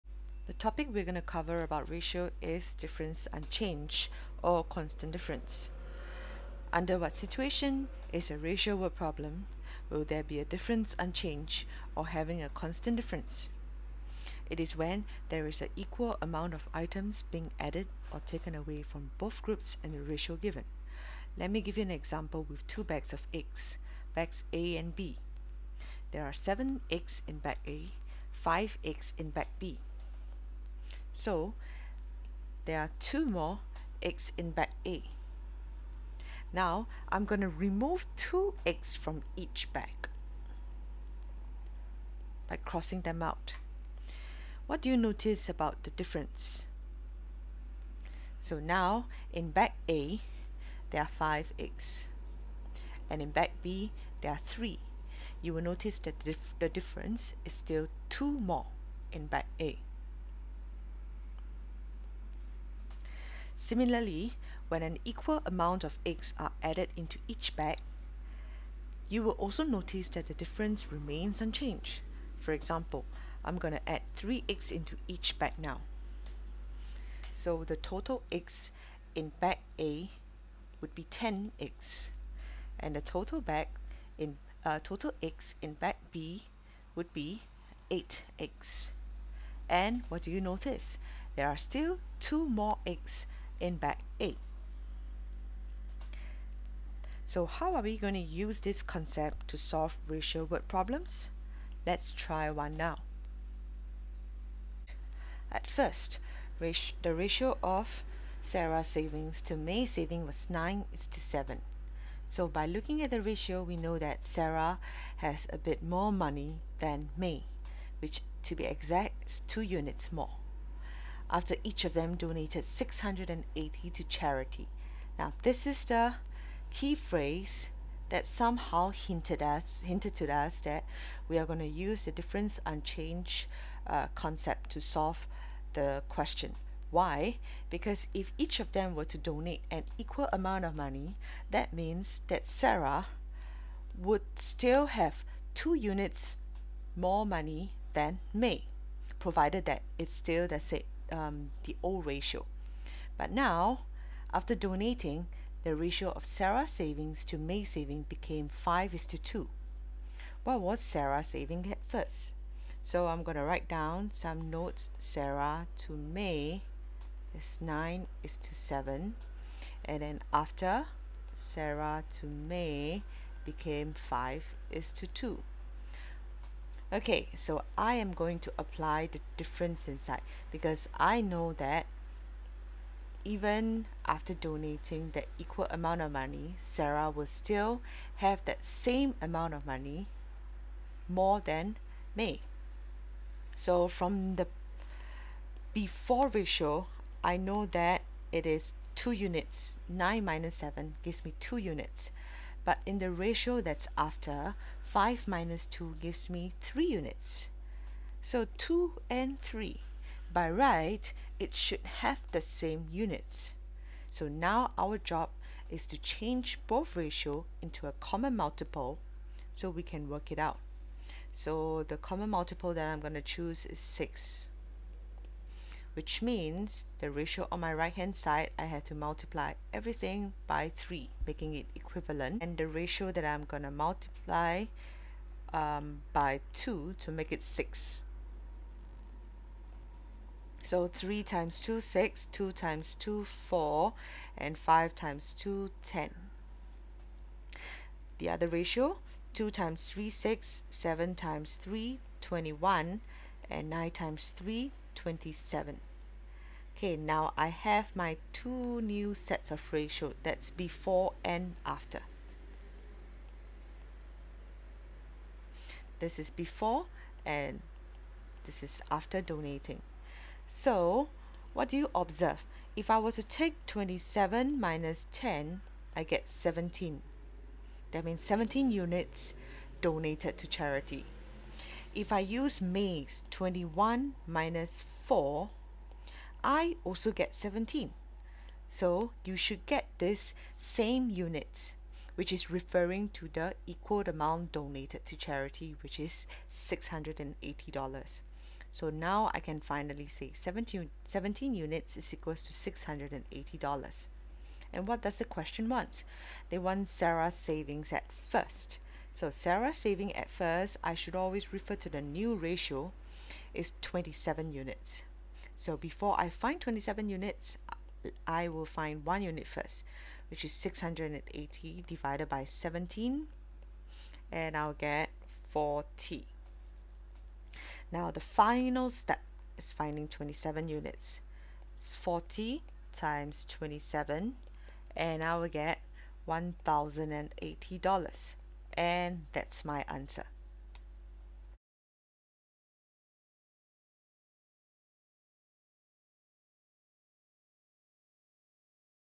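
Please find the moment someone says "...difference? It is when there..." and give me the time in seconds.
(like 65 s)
12 s.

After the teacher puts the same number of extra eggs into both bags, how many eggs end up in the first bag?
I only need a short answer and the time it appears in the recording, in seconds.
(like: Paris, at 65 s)
10 eggs, at 81 s.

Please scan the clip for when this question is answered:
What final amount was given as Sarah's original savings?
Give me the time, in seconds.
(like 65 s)
336 s.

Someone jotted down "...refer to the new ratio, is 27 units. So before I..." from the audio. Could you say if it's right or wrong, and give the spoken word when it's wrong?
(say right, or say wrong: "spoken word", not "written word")
right.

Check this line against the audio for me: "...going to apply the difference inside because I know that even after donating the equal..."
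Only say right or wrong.
right.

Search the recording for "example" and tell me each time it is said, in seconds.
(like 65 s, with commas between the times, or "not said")
21 s, 72 s.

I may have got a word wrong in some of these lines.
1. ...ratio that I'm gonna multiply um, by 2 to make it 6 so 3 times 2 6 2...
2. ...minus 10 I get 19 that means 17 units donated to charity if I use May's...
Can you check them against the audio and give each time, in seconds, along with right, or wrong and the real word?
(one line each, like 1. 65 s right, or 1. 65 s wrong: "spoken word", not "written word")
1. 232 s right
2. 274 s wrong: "17", not "19".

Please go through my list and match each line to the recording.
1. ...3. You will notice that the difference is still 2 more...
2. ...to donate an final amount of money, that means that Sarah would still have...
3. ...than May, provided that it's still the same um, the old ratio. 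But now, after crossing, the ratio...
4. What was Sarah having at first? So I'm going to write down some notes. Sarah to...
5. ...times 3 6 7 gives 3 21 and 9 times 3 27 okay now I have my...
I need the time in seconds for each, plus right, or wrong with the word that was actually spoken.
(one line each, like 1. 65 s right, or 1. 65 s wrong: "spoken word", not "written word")
1. 54 s right
2. 139 s wrong: "equal", not "final"
3. 147 s wrong: "donating", not "crossing"
4. 160 s wrong: "saving", not "having"
5. 249 s wrong: "times", not "gives".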